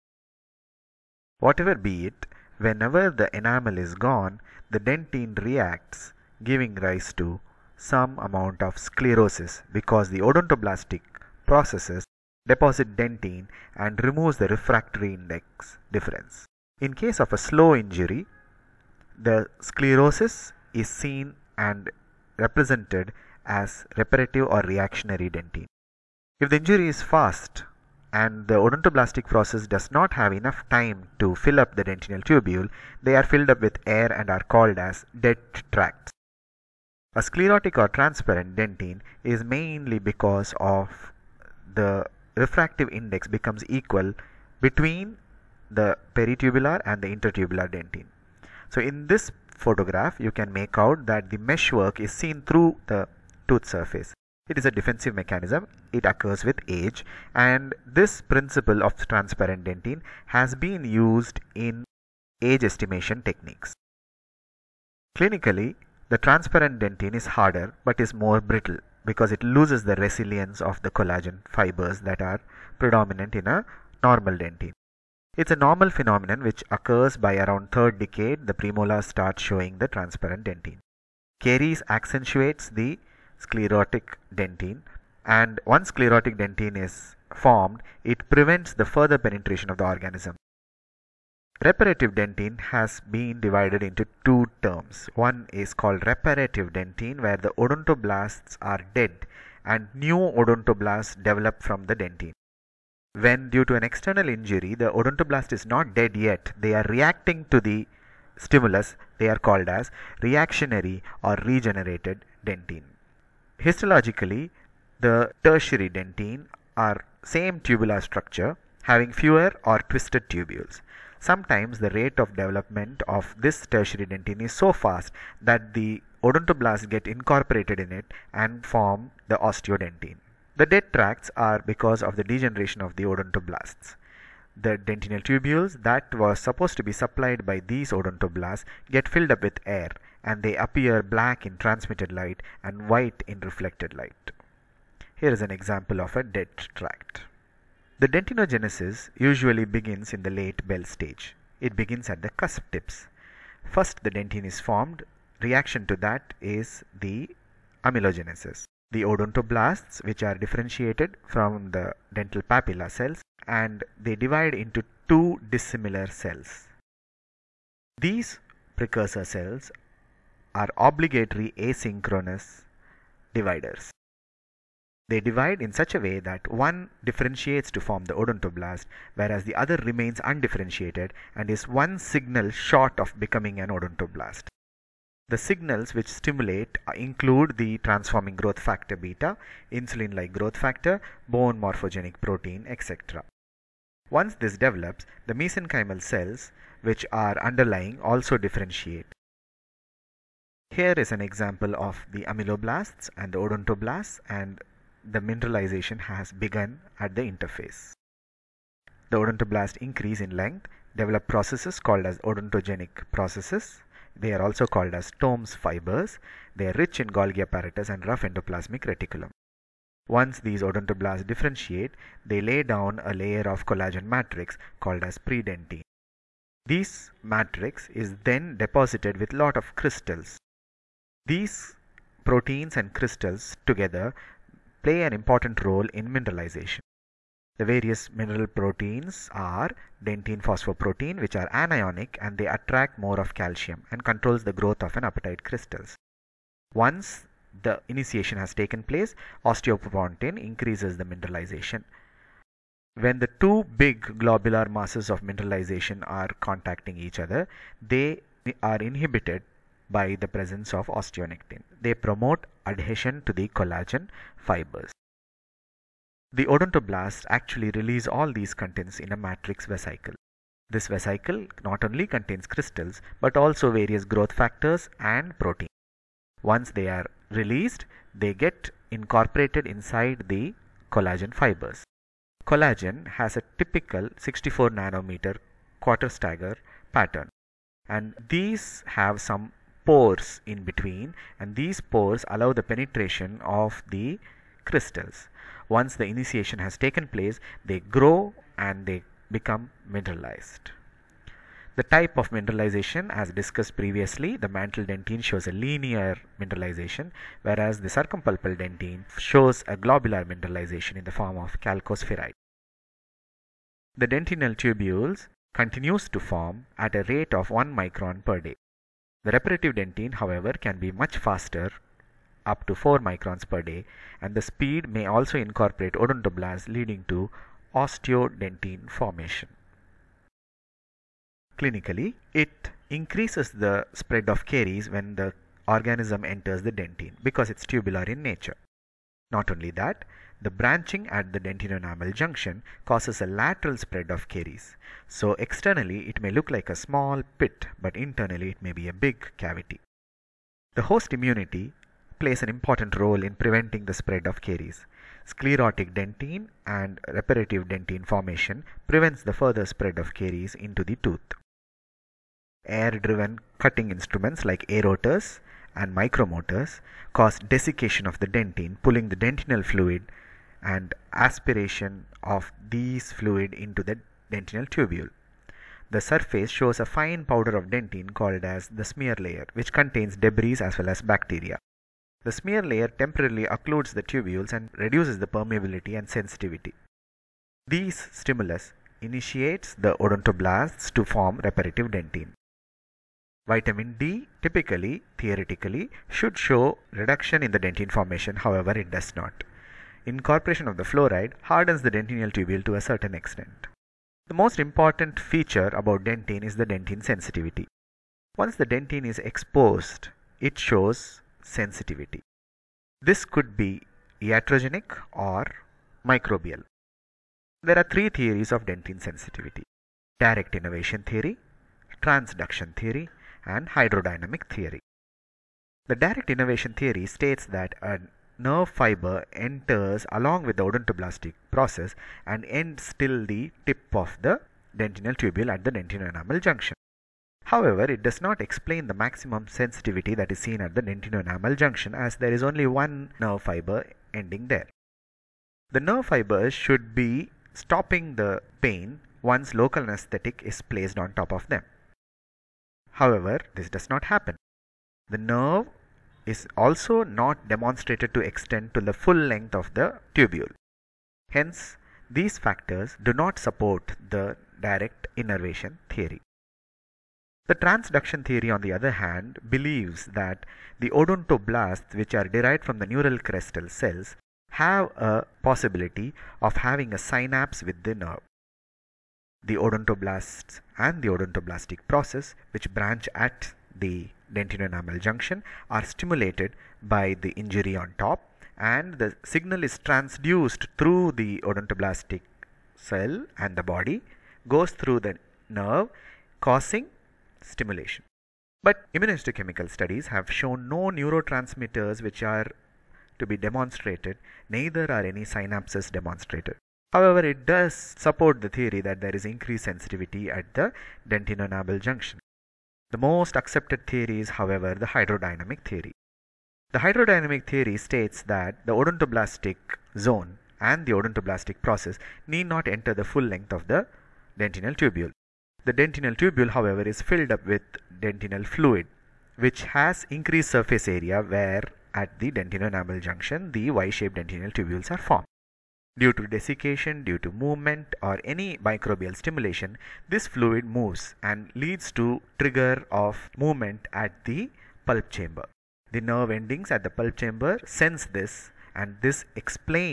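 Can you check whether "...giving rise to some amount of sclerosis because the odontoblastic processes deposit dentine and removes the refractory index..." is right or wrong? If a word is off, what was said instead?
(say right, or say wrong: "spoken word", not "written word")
right.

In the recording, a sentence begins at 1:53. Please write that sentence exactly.
Histologically, the tertiary dentin are same tubular structure having fewer or twisted tubules.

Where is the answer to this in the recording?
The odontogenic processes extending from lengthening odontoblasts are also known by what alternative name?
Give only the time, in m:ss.
3:35.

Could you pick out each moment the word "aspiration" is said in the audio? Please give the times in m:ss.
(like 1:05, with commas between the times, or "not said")
6:11.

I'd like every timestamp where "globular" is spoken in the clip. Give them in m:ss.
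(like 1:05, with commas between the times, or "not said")
4:14, 5:09.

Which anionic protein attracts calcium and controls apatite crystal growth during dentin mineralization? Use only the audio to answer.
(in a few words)
dentine phosphoprotein.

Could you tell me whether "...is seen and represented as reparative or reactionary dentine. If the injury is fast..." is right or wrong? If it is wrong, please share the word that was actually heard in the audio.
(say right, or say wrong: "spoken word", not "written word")
right.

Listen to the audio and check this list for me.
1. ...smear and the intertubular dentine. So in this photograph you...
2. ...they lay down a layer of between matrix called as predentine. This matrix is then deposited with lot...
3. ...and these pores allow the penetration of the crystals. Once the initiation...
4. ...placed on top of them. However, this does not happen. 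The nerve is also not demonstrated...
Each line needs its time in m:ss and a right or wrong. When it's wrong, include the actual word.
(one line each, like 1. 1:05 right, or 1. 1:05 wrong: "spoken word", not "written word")
1. 0:46 wrong: "peritubular", not "smear"
2. 3:42 wrong: "collagen", not "between"
3. 4:51 right
4. 7:30 right.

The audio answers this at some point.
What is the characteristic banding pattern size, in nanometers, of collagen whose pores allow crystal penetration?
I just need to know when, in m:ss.
4:44.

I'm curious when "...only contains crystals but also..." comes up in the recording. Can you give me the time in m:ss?
4:31.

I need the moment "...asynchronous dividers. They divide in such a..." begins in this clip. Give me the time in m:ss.
2:51.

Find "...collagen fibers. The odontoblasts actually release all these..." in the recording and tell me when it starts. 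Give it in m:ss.
4:23.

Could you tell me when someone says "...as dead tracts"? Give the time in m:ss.
0:34.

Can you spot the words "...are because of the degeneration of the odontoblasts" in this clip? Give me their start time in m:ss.
2:11.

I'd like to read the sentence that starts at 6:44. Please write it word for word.
The most important feature about dentine is the dentine sensitivity.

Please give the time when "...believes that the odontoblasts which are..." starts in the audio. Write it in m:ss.
7:49.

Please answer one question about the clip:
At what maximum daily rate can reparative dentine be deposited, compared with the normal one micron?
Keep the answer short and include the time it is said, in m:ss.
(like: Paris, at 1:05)
4 microns per day, at 5:22.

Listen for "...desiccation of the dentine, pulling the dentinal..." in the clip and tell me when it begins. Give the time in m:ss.
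6:07.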